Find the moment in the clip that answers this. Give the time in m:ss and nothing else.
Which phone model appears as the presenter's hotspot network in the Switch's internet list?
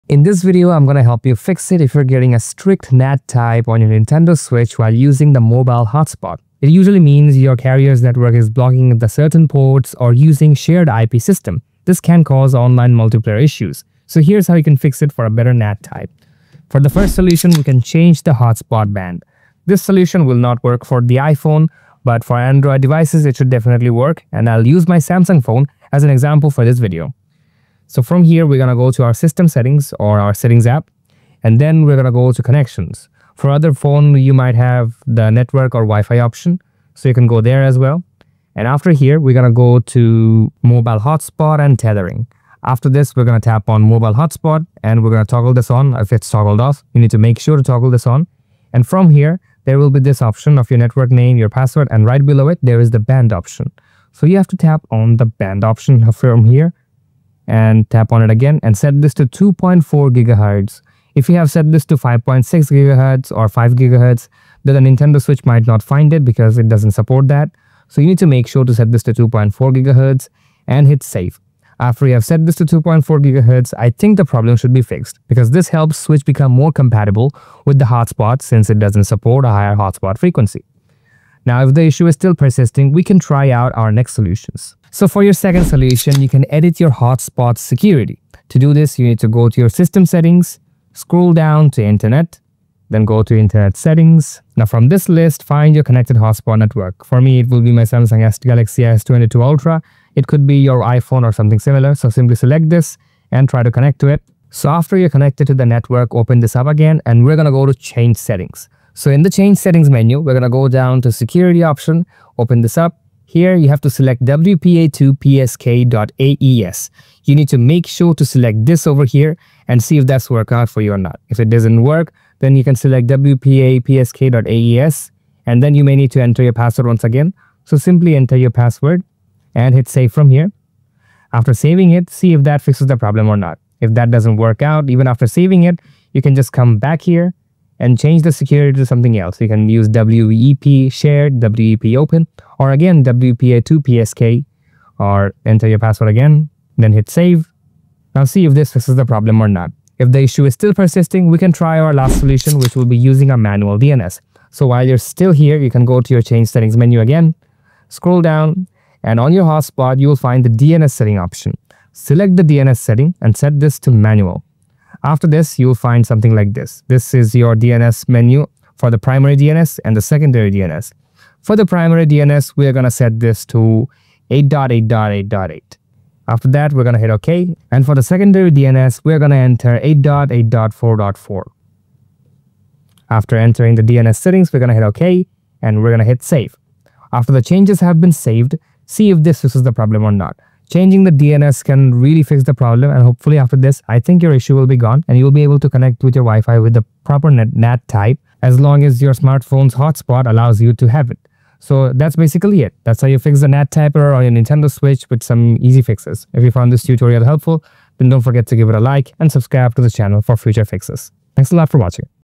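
1:38.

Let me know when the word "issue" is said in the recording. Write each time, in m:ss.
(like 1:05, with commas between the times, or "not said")
0:13, 1:21, 2:30, 3:14.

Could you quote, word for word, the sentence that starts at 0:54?
So you have to tap on the band option from here and tap on it again and set this to 2.4 gigahertz.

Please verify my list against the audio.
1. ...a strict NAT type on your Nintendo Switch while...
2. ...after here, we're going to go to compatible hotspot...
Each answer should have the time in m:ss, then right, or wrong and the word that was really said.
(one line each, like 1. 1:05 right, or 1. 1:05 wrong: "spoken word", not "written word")
1. 0:02 right
2. 0:38 wrong: "mobile", not "compatible".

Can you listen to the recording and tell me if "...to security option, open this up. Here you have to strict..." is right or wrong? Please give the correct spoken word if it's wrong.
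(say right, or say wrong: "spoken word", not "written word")
wrong: "select", not "strict".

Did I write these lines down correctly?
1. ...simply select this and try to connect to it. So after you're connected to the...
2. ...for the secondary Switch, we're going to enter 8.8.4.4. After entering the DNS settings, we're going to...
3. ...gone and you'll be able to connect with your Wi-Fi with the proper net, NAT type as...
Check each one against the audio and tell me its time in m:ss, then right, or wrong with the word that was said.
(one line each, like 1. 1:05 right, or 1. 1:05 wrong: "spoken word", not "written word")
1. 1:42 right
2. 2:57 wrong: "DNS", not "Switch"
3. 3:14 right.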